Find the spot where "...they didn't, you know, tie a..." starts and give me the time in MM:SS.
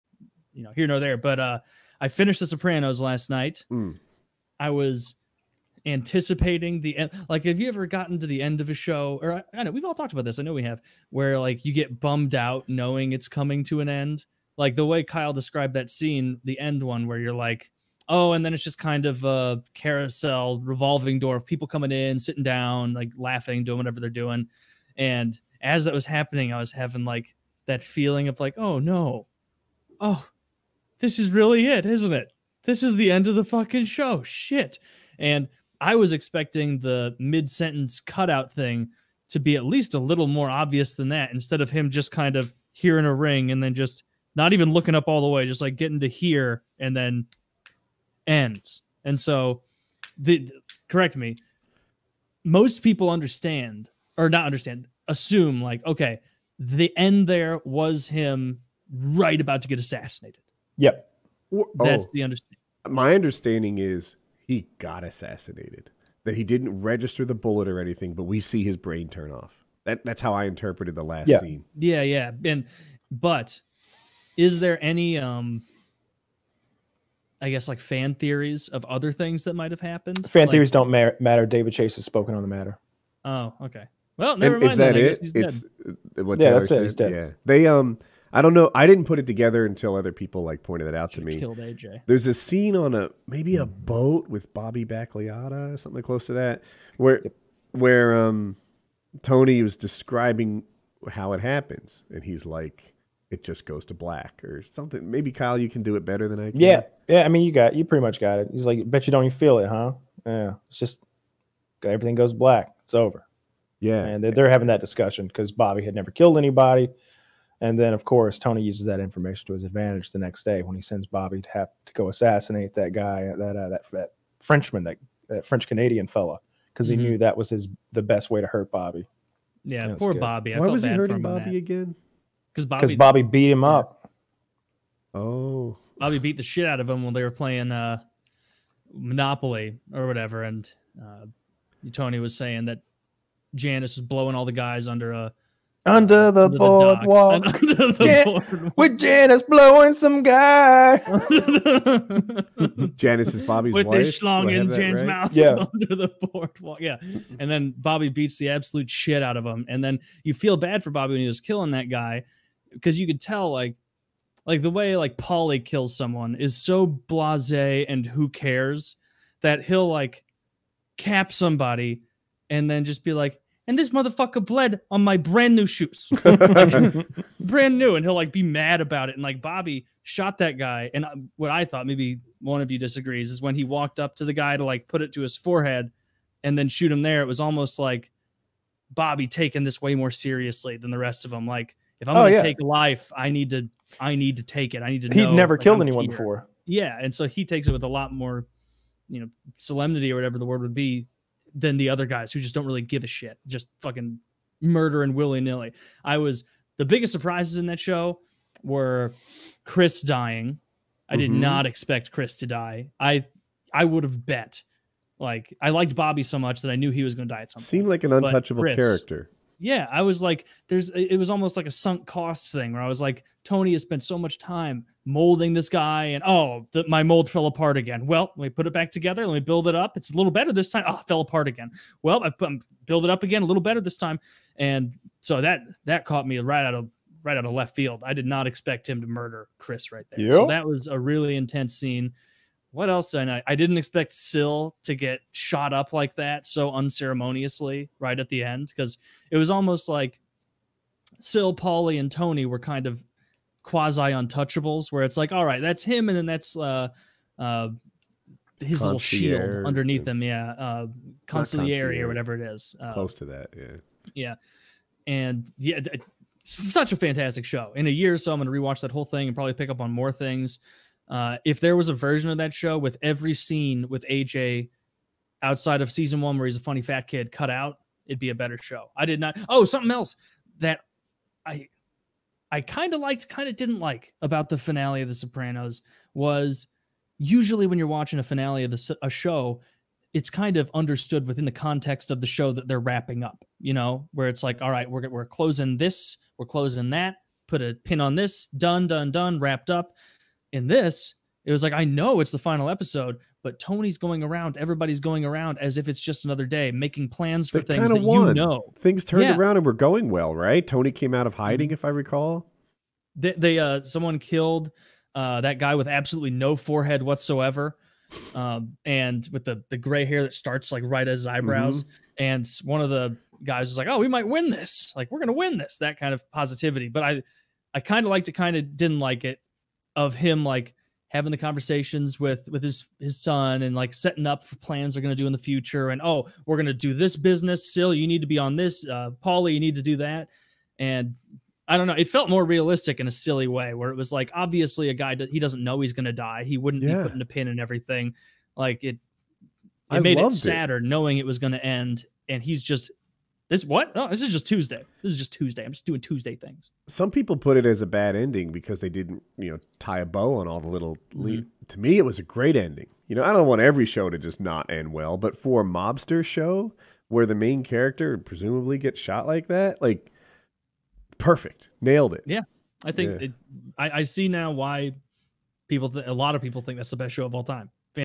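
05:58.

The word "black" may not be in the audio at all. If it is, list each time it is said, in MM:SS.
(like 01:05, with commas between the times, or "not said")
01:43, 01:52.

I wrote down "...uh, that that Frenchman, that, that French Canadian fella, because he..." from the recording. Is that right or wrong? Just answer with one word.
right.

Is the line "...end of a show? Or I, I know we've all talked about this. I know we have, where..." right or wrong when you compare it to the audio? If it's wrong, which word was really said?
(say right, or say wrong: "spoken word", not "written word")
right.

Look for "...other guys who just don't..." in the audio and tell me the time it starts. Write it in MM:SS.
03:21.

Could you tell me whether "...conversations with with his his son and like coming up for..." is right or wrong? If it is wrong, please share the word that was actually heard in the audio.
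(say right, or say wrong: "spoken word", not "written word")
wrong: "setting", not "coming".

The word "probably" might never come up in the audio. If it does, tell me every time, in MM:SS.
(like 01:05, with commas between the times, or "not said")
04:29.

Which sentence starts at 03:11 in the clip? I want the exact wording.
Like, if I'm oh, gonna yeah.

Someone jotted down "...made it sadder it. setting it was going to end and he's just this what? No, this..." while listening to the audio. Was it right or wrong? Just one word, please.
wrong.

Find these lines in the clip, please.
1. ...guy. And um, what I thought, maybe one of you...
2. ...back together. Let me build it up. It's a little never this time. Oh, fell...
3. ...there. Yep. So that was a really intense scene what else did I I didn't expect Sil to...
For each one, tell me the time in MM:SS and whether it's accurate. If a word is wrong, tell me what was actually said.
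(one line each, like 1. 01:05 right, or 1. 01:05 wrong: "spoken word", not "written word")
1. 03:00 right
2. 03:48 wrong: "better", not "never"
3. 04:00 right.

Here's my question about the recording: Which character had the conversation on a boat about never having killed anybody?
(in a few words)
Bobby Bacliotta.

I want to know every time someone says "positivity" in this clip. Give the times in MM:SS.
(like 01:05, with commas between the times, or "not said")
05:26.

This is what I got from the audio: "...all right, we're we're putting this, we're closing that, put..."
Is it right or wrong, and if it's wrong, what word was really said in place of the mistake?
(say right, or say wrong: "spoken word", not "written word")
wrong: "closing", not "putting".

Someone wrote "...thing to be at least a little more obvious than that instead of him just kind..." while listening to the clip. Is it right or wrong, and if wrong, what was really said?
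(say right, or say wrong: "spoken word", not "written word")
right.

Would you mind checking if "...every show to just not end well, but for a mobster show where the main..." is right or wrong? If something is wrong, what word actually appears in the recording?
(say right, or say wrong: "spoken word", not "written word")
right.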